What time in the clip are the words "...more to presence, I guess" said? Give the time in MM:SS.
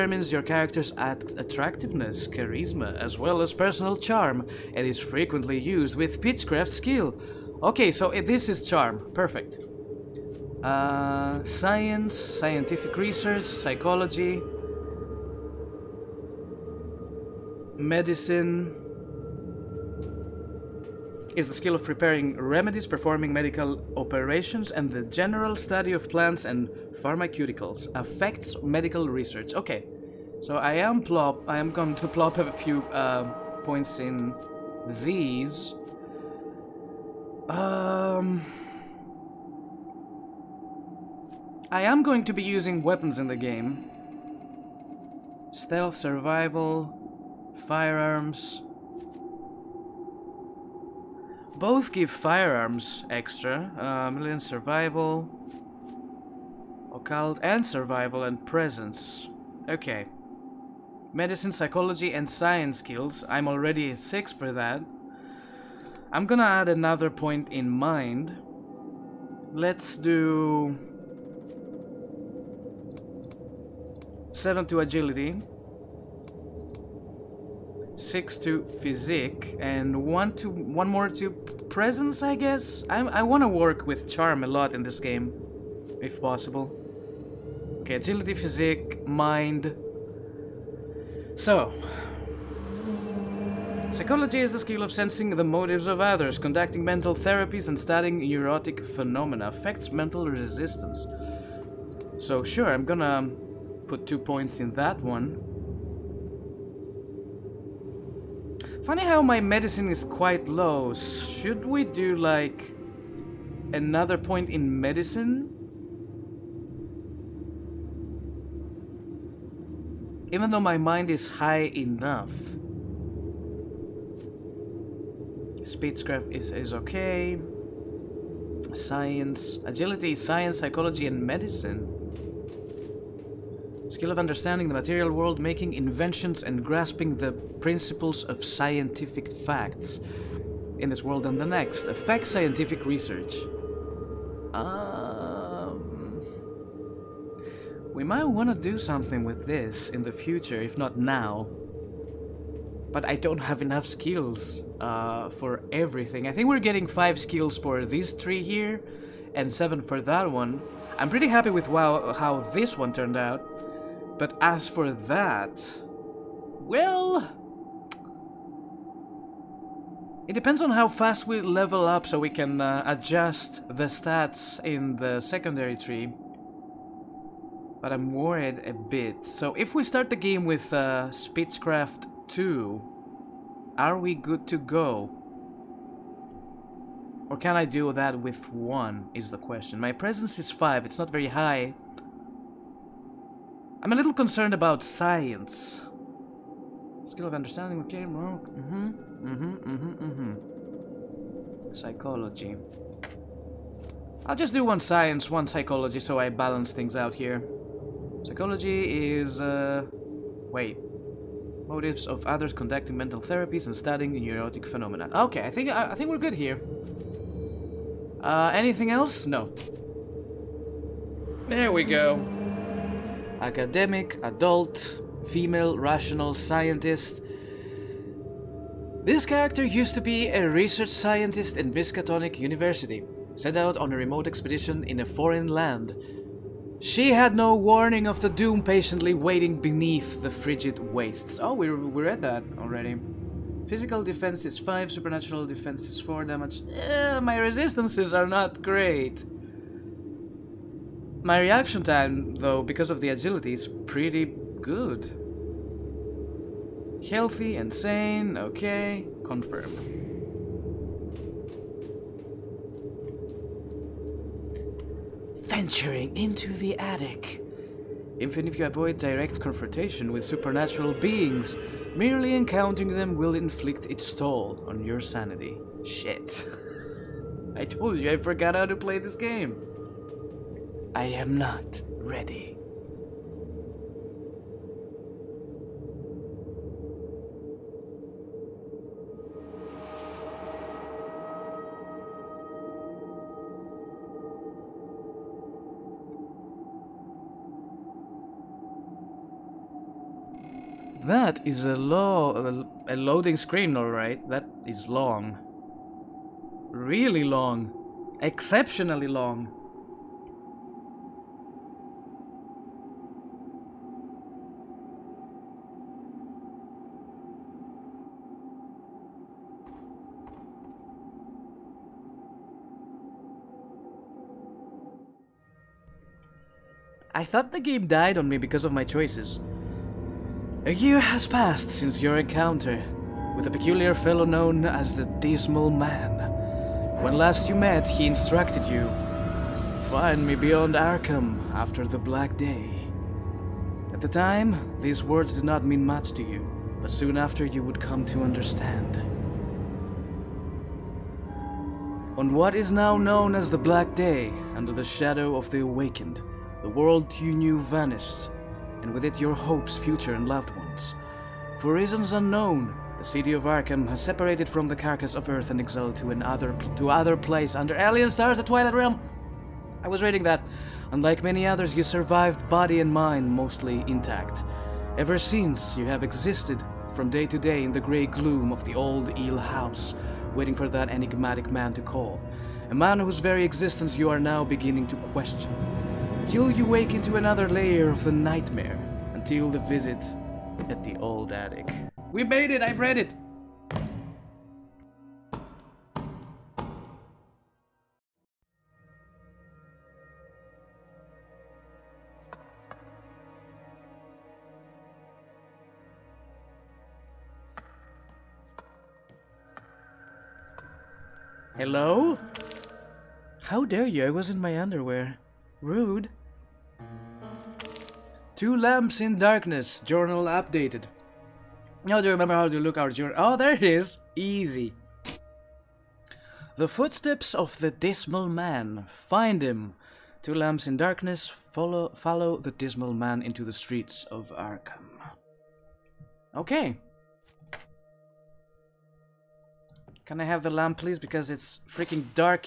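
01:20.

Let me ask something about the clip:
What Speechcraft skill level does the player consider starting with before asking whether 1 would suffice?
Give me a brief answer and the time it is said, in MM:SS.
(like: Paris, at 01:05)
2, at 03:01.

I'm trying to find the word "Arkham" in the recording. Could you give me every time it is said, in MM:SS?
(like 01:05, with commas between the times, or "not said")
05:40, 06:03, 07:14.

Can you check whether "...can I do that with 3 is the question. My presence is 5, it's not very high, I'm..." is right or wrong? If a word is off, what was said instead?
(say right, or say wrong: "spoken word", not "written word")
wrong: "1", not "3".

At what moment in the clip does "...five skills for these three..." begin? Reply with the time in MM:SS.
02:36.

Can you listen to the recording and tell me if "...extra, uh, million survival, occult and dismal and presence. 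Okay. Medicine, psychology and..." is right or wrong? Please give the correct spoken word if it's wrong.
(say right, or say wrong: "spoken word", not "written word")
wrong: "survival", not "dismal".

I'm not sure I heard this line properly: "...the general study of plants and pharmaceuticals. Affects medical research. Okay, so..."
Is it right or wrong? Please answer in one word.
right.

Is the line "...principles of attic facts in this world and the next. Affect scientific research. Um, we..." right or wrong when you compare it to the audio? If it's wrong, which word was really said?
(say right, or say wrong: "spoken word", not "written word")
wrong: "scientific", not "attic".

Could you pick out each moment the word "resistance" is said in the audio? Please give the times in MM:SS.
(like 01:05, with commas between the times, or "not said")
01:40, 04:07.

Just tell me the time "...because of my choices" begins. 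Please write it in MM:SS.
05:28.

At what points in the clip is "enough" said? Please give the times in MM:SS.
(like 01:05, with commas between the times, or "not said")
02:01, 02:33.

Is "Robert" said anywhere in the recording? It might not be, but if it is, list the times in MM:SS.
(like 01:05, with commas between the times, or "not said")
not said.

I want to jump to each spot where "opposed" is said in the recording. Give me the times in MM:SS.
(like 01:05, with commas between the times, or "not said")
not said.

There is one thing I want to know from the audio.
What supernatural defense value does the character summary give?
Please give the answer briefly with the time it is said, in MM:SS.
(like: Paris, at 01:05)
4, at 04:04.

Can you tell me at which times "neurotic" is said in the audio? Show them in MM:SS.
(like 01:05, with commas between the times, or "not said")
01:38, 03:34.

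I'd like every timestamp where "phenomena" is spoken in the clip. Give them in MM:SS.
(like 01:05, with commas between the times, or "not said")
01:38, 03:34.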